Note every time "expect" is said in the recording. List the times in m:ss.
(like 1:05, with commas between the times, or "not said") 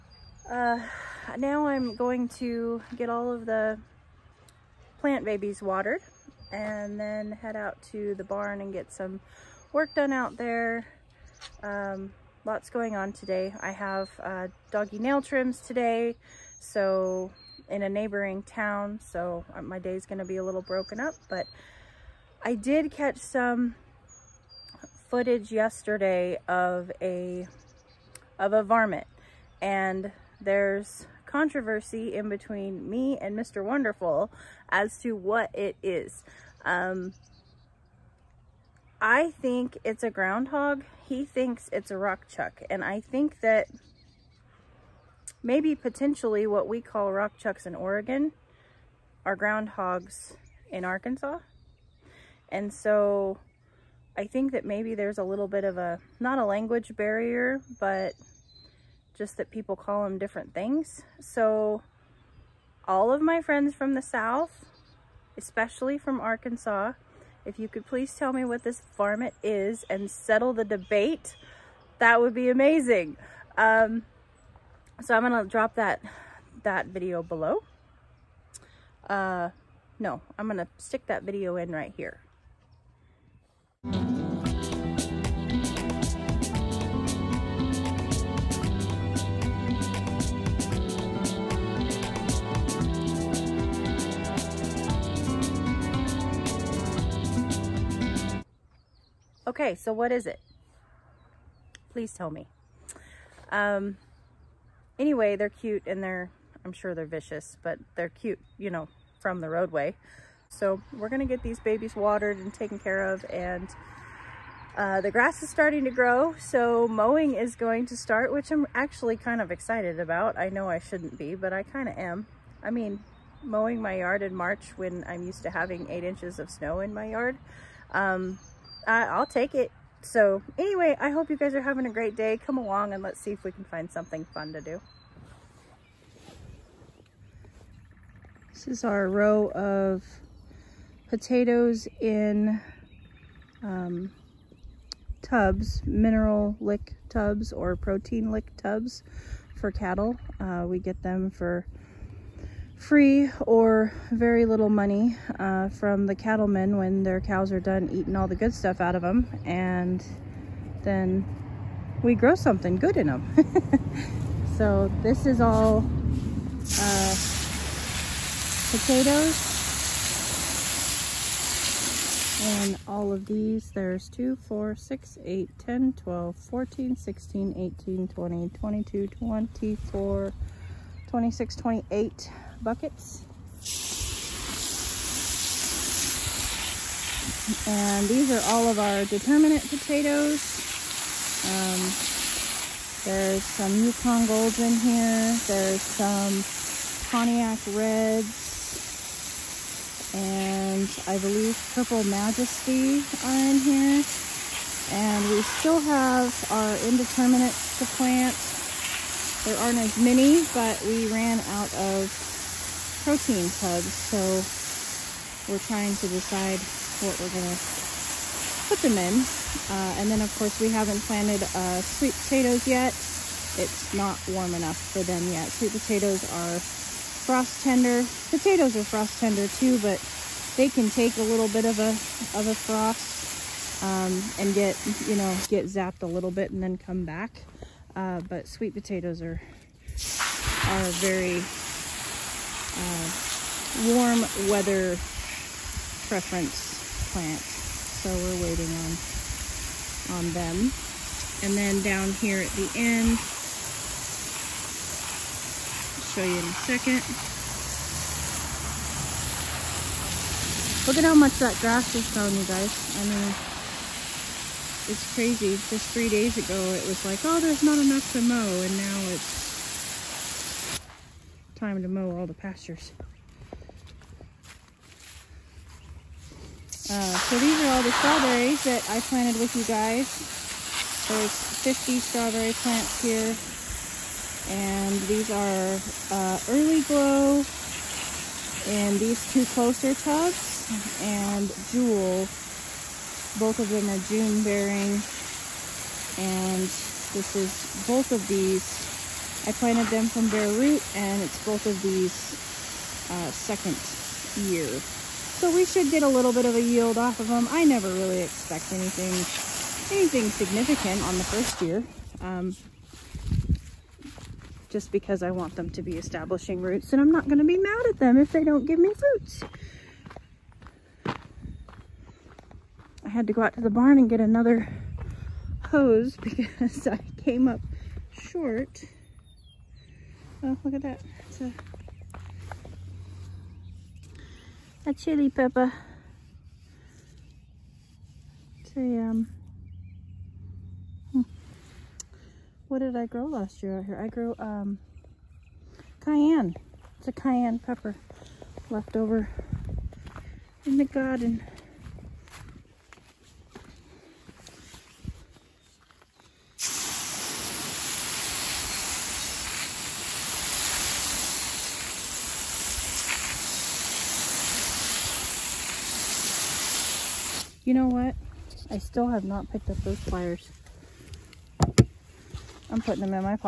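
5:08.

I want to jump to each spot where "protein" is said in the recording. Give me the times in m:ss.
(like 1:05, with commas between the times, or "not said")
2:27, 3:33.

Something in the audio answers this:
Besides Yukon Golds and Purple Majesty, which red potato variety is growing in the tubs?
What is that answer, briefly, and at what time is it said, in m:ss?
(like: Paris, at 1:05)
Pontiac Reds, at 3:17.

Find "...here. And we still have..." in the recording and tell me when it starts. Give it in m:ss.
3:23.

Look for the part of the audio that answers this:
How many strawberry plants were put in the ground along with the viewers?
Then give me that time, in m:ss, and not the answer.
4:41.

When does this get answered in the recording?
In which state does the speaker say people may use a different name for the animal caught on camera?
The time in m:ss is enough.
0:47.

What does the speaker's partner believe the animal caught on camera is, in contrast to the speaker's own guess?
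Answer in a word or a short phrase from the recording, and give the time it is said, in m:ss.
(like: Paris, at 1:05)
rock chuck, at 0:41.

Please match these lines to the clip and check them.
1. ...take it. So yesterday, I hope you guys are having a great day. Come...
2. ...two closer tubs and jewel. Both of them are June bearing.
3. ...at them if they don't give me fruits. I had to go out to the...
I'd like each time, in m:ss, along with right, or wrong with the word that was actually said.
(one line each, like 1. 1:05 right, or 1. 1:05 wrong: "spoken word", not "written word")
1. 2:09 wrong: "anyway", not "yesterday"
2. 4:49 right
3. 5:17 right.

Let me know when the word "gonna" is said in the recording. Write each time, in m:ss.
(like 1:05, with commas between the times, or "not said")
0:20, 1:15, 1:20, 3:37.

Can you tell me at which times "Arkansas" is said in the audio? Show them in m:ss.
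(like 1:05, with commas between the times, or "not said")
0:50, 1:06.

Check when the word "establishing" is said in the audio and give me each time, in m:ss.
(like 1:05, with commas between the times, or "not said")
5:15.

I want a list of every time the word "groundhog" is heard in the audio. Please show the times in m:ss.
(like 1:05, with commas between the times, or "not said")
0:40, 0:49.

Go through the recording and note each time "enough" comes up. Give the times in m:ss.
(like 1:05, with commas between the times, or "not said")
3:44, 4:27.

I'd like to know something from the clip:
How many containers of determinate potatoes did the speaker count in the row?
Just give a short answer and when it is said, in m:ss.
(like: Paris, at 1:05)
28, at 3:01.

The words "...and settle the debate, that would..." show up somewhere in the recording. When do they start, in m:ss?
1:09.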